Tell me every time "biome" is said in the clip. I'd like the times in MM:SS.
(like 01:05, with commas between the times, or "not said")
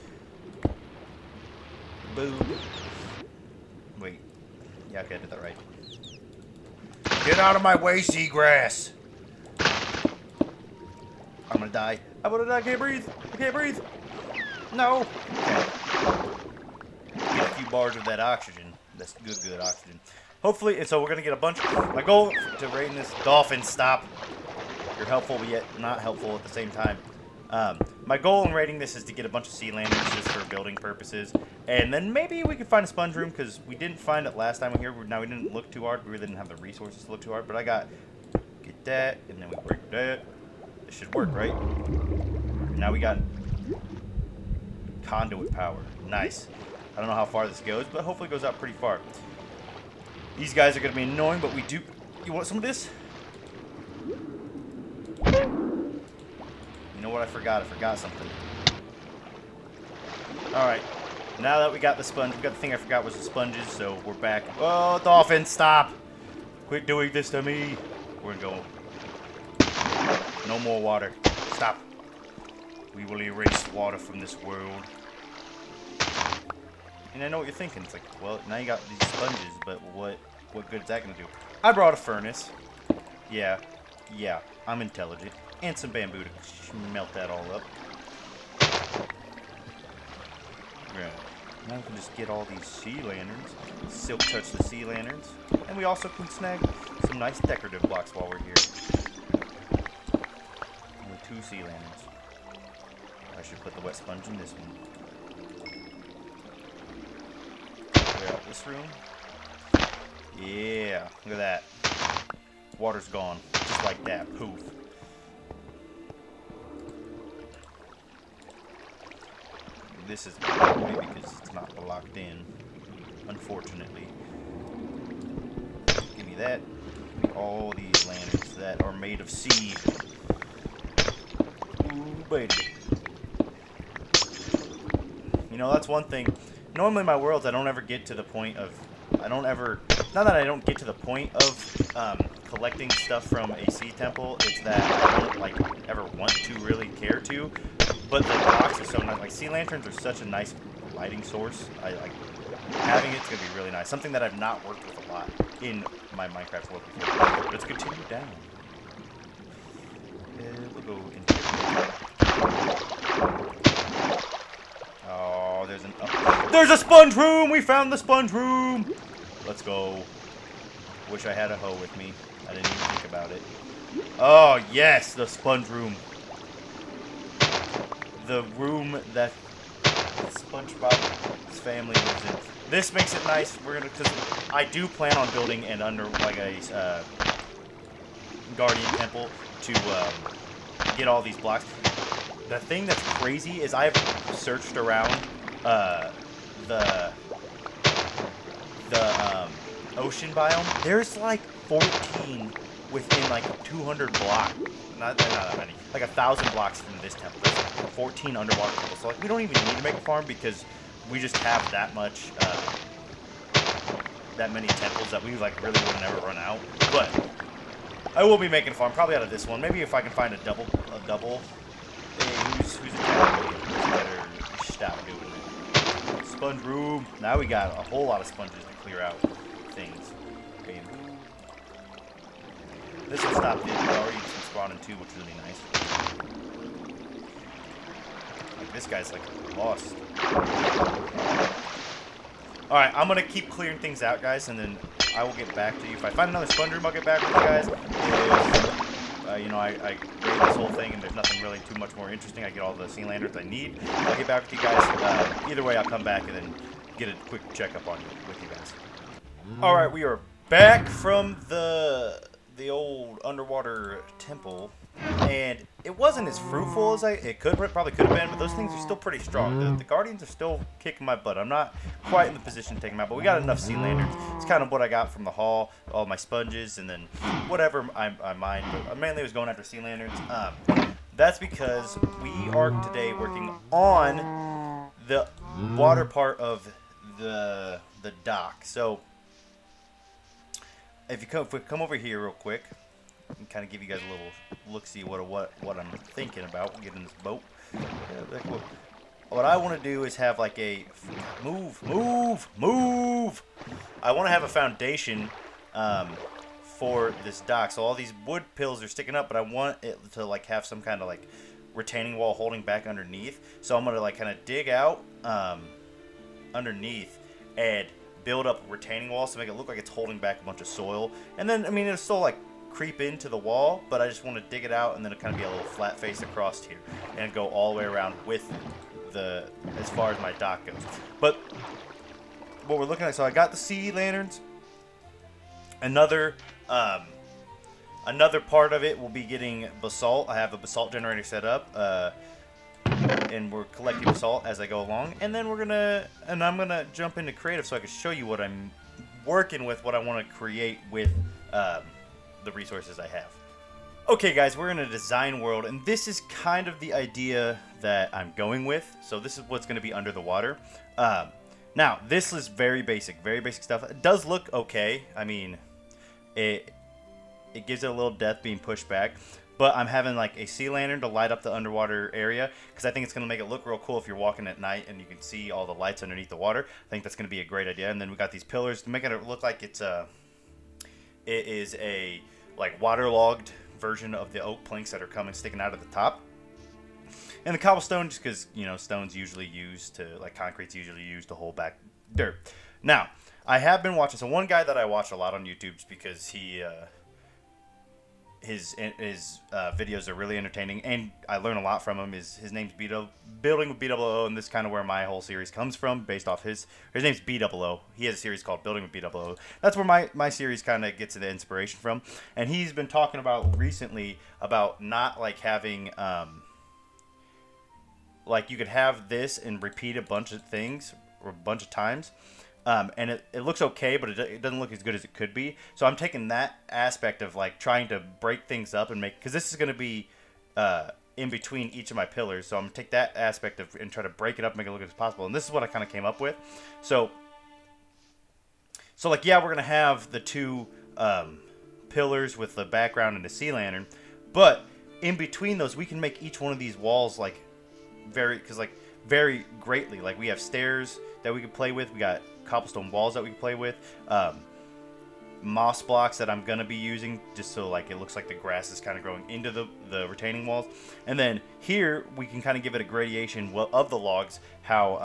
03:20.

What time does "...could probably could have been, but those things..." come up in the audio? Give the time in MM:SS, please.
04:27.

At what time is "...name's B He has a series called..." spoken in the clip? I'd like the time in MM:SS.
06:47.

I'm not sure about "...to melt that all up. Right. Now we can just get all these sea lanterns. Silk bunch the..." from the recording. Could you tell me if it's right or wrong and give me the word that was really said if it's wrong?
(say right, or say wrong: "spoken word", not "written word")
wrong: "touch", not "bunch".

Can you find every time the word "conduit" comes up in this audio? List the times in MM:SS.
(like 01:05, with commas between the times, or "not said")
00:45.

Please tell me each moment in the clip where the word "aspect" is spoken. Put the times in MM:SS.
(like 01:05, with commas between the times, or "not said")
07:06, 07:13.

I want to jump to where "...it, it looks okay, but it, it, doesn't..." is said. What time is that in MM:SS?
07:03.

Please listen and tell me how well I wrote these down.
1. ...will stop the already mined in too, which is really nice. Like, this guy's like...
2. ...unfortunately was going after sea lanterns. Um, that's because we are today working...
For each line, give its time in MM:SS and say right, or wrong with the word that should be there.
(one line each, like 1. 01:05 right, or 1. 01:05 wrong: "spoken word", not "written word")
1. 03:53 wrong: "spawned", not "mined"
2. 04:38 wrong: "mainly", not "unfortunately".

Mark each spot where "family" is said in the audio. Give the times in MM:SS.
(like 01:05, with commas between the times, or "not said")
03:01.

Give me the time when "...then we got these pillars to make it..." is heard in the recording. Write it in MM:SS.
06:18.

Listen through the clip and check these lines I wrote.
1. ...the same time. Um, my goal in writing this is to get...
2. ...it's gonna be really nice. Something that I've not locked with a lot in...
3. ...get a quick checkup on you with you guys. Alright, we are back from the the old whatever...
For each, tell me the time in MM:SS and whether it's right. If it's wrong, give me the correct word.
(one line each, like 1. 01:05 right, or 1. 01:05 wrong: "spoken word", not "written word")
1. 00:26 right
2. 02:33 wrong: "worked", not "locked"
3. 04:16 wrong: "underwater", not "whatever".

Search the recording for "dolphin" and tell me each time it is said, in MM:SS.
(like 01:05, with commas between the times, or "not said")
00:23, 01:05.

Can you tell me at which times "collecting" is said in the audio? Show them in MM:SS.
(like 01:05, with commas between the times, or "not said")
02:22, 05:43.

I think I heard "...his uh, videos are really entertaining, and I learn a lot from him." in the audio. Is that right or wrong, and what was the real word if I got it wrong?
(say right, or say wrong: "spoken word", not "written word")
right.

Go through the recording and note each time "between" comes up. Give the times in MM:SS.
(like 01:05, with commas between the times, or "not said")
07:11, 07:25.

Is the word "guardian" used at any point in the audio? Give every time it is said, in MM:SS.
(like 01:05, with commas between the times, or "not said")
03:08, 04:29.